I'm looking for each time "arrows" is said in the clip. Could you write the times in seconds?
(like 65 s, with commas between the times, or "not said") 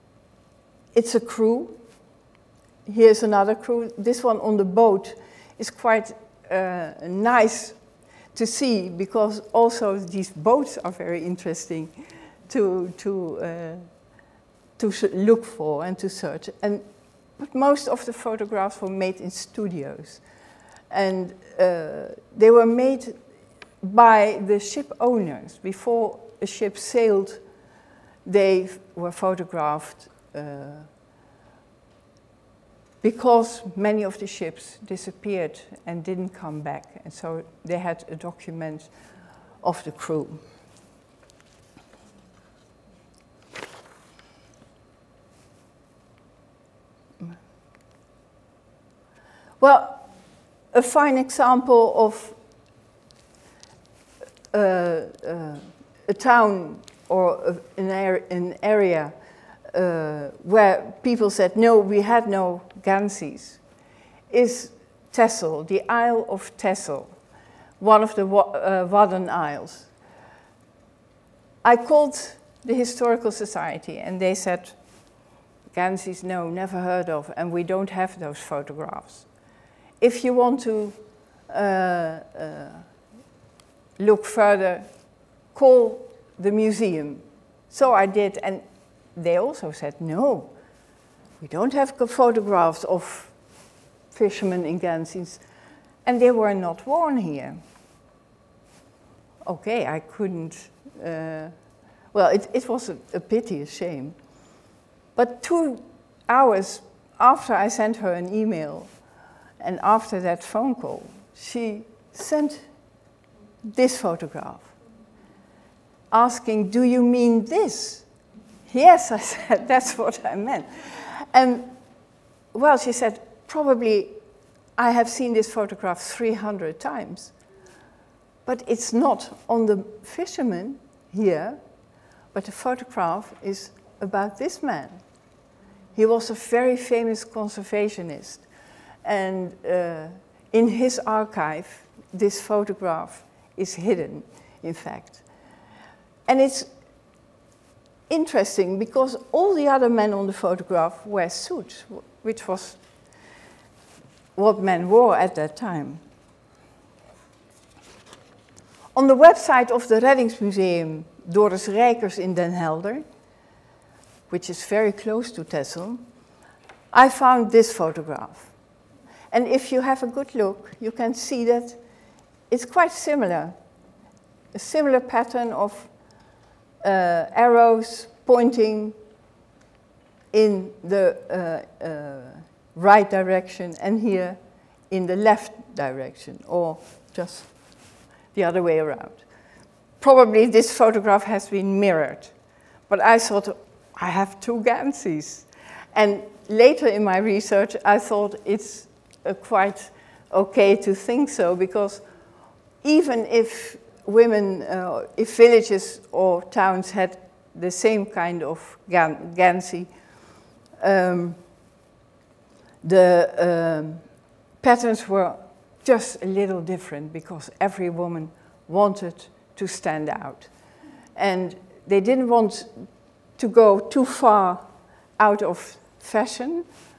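177 s.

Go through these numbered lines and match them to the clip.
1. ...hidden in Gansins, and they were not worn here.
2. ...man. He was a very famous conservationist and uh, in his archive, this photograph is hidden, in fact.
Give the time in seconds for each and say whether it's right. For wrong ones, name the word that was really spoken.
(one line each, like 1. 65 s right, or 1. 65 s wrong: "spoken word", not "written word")
1. 94 s wrong: "fishermen", not "hidden"
2. 134 s right.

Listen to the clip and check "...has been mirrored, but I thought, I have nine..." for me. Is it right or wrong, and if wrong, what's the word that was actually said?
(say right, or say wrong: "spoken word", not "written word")
wrong: "two", not "nine".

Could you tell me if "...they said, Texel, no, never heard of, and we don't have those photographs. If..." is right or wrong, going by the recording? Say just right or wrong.
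wrong.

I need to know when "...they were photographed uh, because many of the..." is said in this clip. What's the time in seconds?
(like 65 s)
28 s.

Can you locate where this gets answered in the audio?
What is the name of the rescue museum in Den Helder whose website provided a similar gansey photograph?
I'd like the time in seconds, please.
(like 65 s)
159 s.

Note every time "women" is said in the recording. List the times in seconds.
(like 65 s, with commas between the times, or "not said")
204 s.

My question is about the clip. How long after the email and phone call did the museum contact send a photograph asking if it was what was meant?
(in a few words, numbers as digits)
2 hours.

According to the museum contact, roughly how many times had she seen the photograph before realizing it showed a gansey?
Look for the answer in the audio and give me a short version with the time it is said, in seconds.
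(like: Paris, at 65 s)
300, at 125 s.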